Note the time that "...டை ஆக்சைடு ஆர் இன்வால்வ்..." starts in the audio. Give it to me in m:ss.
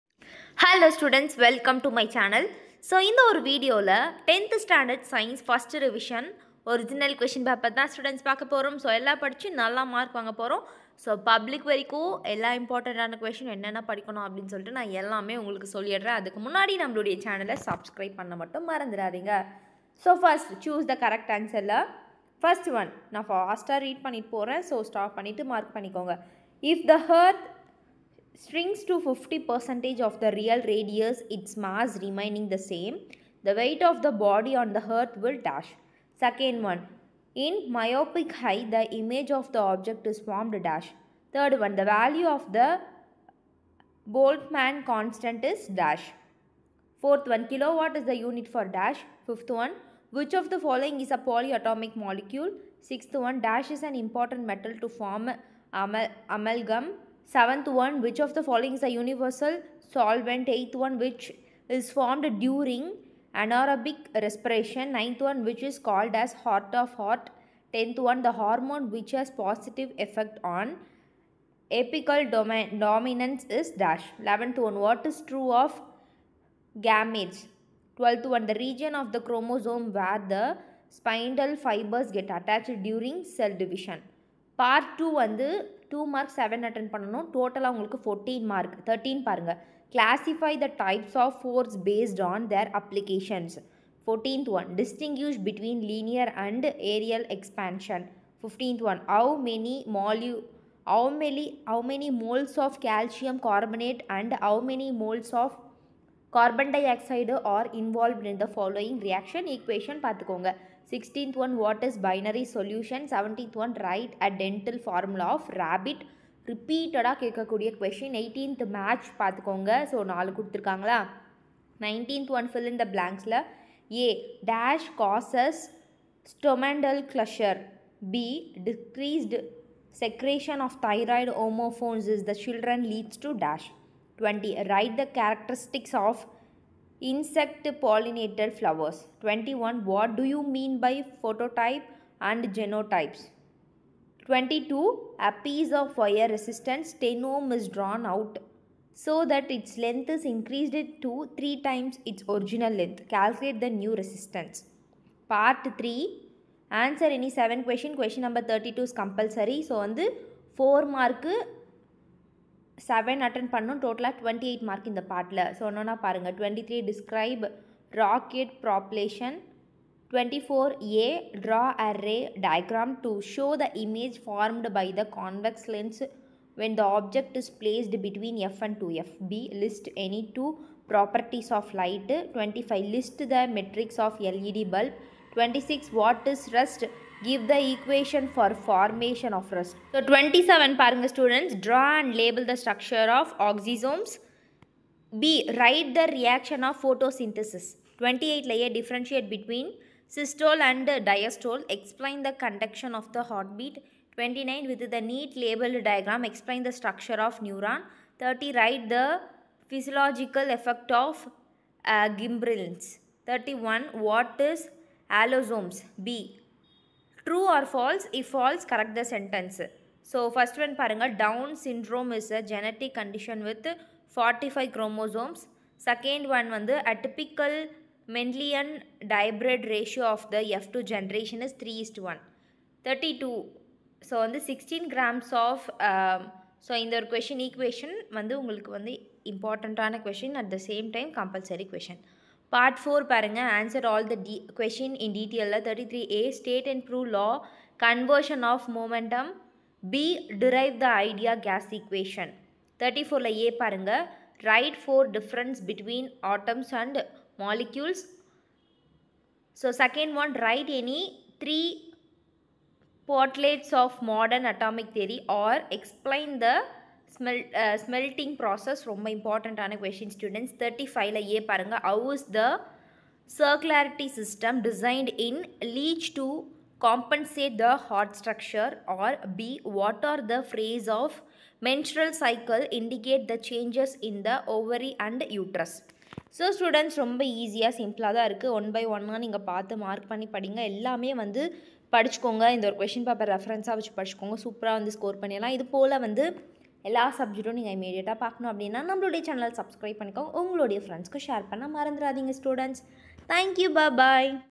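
1:46.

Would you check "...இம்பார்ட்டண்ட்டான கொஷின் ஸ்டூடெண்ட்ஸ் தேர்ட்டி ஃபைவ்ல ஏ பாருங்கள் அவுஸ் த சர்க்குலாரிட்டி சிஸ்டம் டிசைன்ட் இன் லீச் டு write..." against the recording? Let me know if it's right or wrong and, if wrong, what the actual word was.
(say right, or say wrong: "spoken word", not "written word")
wrong: "compensate", not "write".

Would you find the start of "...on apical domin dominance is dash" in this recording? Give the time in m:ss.
1:10.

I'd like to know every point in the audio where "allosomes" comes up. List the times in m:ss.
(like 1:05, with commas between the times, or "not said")
3:35.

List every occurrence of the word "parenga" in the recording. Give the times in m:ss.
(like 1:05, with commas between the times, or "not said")
4:03, 4:13.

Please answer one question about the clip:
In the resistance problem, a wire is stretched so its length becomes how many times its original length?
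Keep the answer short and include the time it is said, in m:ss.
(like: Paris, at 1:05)
3 times, at 2:31.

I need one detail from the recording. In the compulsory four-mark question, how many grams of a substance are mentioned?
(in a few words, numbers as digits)
16 grams.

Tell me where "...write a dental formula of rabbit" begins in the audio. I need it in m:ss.
1:53.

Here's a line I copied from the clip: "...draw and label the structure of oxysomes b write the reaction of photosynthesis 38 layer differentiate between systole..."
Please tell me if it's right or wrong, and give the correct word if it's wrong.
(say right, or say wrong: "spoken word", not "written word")
wrong: "28", not "38".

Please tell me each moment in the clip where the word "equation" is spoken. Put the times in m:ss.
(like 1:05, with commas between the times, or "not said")
3:07, 4:11.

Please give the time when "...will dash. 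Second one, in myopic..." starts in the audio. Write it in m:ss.
0:35.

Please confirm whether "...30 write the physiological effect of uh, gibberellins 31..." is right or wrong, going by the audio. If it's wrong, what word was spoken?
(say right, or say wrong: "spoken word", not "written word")
right.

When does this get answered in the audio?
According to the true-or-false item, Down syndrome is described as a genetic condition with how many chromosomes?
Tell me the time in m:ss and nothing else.
3:44.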